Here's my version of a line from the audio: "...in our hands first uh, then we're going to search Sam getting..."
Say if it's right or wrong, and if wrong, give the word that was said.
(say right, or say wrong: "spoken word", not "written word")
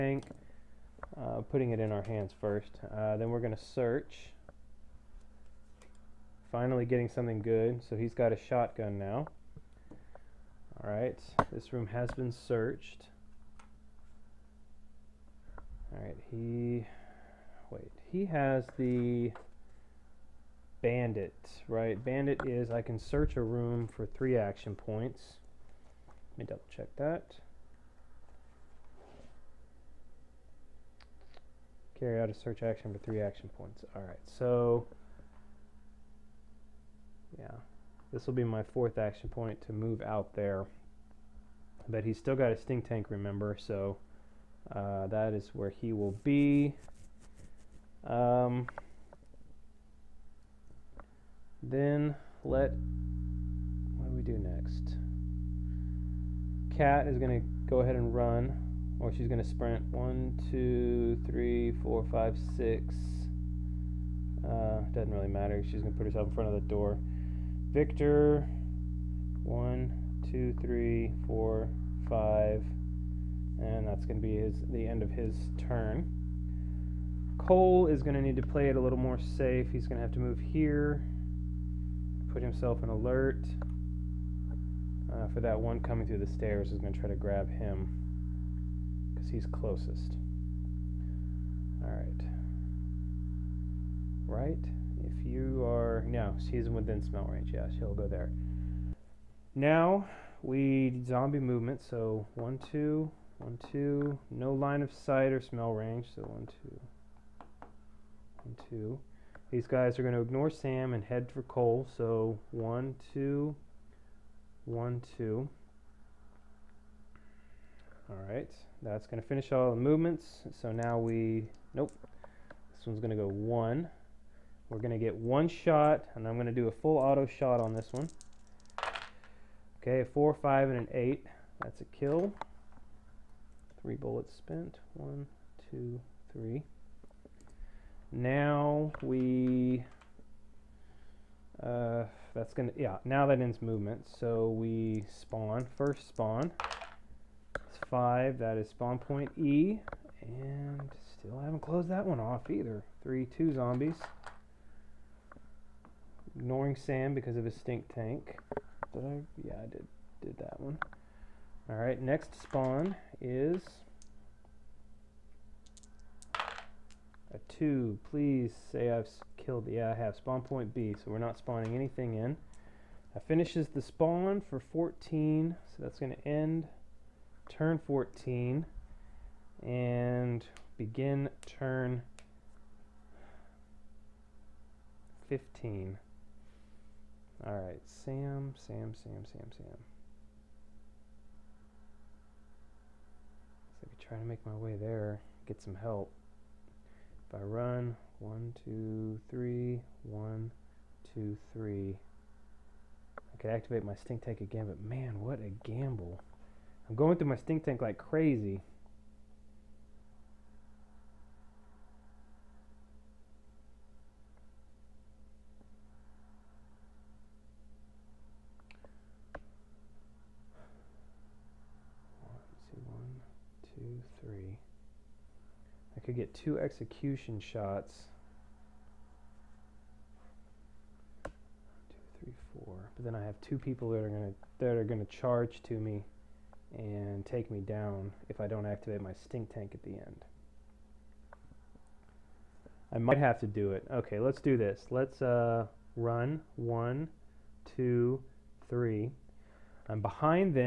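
wrong: "Finally", not "Sam".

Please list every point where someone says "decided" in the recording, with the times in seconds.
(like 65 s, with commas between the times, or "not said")
not said.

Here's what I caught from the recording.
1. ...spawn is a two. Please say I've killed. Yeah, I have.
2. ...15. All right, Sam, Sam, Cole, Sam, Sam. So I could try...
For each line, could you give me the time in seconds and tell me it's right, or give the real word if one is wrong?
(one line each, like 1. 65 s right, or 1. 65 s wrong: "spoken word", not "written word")
1. 162 s right
2. 185 s wrong: "Sam", not "Cole".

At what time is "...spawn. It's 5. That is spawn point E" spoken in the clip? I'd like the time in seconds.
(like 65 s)
146 s.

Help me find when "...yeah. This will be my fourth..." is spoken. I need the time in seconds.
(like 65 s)
37 s.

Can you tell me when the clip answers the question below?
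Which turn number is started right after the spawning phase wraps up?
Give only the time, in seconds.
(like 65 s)
181 s.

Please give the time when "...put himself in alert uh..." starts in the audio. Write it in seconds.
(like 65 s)
82 s.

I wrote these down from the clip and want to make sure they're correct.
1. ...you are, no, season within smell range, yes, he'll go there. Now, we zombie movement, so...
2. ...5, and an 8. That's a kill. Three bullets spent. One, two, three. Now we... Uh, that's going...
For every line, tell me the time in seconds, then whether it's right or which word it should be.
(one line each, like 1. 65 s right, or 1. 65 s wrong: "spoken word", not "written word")
1. 95 s right
2. 130 s right.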